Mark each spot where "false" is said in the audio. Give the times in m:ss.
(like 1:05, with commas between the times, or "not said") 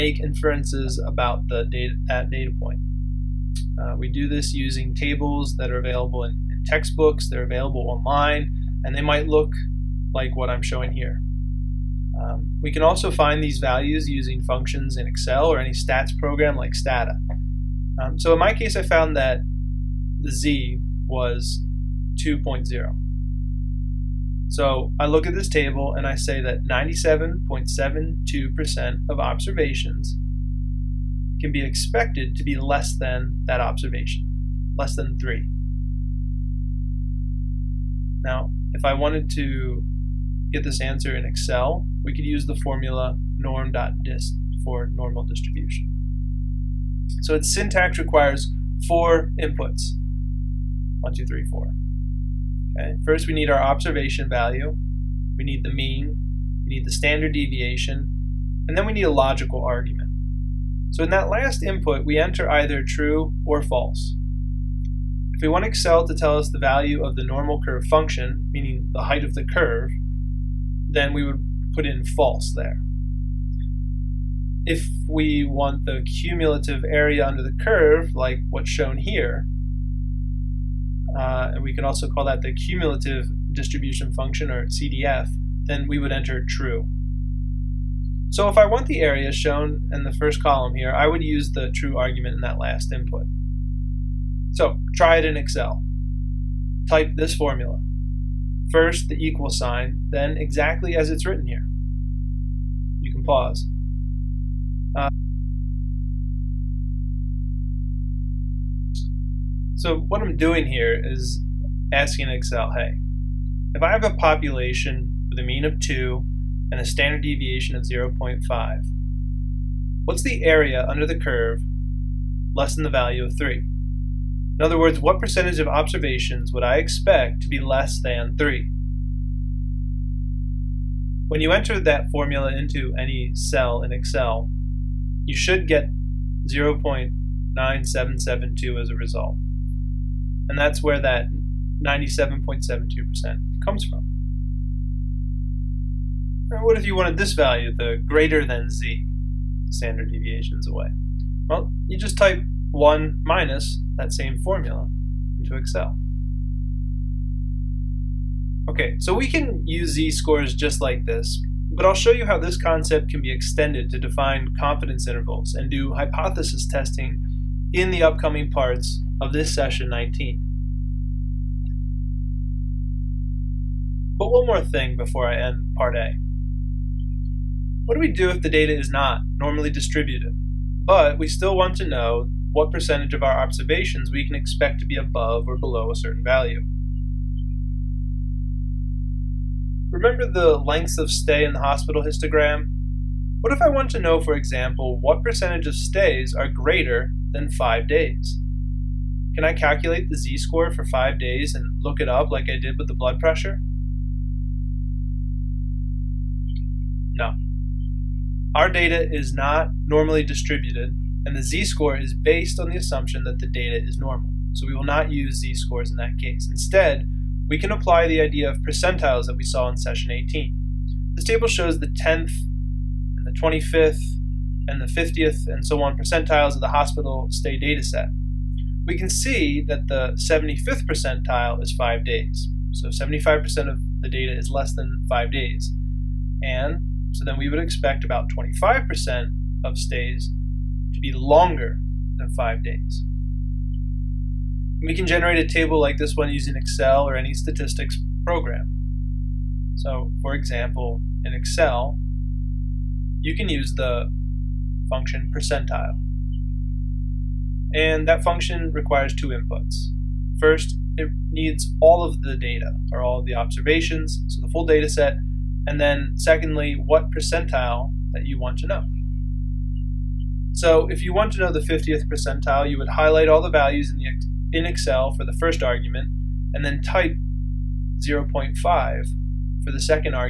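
1:03, 1:12.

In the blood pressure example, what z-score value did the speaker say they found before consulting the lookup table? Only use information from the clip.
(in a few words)
2.0.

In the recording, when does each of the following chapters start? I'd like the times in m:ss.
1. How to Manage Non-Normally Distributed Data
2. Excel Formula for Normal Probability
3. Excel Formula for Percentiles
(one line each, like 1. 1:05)
1. 2:53
2. 0:38
3. 4:08.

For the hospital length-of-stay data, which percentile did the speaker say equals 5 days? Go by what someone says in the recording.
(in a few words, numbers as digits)
75th percentile.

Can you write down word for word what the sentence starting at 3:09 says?
Remember the lengths of stay in the hospital histogram?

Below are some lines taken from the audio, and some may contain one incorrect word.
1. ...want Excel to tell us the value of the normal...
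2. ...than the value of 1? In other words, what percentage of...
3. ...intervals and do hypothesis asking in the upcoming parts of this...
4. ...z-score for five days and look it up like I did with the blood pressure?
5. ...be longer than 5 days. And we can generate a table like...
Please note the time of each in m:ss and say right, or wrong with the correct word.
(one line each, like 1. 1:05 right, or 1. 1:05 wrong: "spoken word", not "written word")
1. 1:05 right
2. 2:02 wrong: "3", not "1"
3. 2:45 wrong: "testing", not "asking"
4. 3:20 right
5. 4:01 right.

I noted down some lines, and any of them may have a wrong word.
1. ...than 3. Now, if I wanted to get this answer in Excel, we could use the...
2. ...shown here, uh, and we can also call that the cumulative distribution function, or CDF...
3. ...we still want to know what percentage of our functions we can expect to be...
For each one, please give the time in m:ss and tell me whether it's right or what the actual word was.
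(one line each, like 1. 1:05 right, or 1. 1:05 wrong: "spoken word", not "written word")
1. 0:34 right
2. 1:18 right
3. 3:01 wrong: "observations", not "functions".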